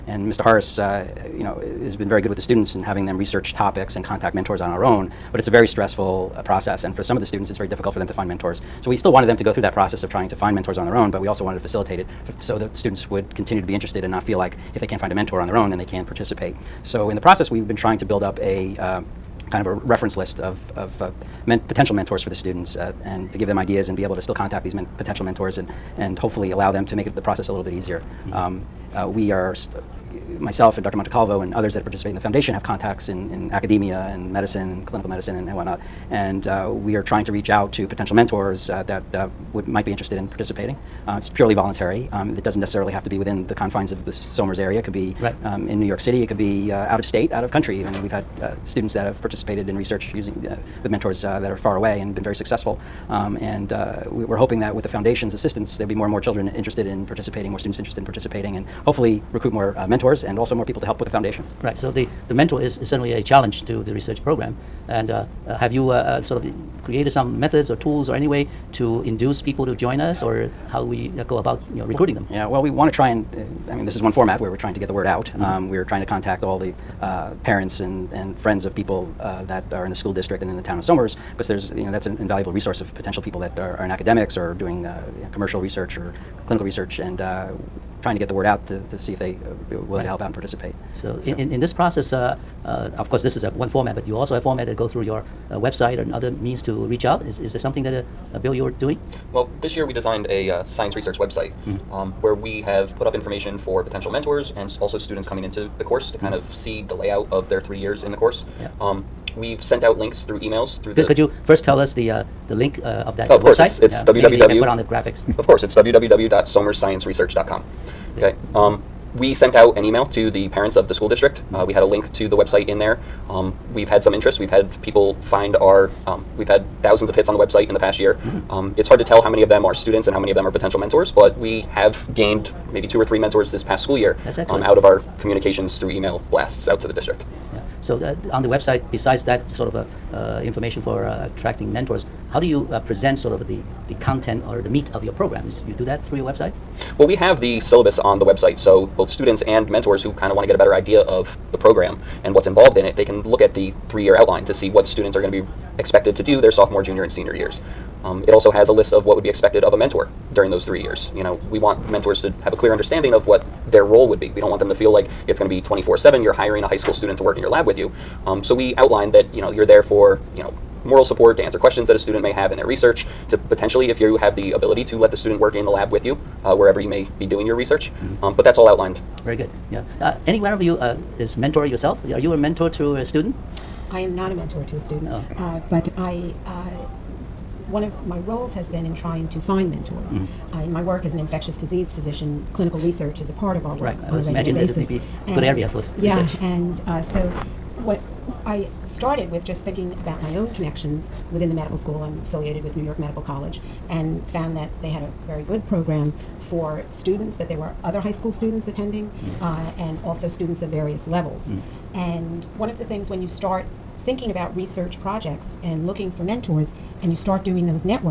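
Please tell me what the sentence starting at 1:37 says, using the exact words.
Is, is there something that, uh, uh, Bill, you're doing?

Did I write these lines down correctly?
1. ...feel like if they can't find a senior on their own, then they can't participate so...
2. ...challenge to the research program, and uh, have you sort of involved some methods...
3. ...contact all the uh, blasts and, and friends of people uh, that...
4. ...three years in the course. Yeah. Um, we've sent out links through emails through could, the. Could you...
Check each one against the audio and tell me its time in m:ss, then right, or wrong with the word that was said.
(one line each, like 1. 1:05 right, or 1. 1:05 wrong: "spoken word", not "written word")
1. 0:14 wrong: "mentor", not "senior"
2. 1:03 wrong: "created", not "involved"
3. 1:16 wrong: "parents", not "blasts"
4. 1:47 right.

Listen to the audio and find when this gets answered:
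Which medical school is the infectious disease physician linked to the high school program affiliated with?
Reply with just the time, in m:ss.
3:22.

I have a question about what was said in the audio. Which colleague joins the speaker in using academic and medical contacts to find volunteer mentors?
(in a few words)
Dr. Montecalvo.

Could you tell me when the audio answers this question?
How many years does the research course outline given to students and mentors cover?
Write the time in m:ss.
2:33.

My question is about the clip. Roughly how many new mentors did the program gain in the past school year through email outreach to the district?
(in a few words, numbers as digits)
2 or 3.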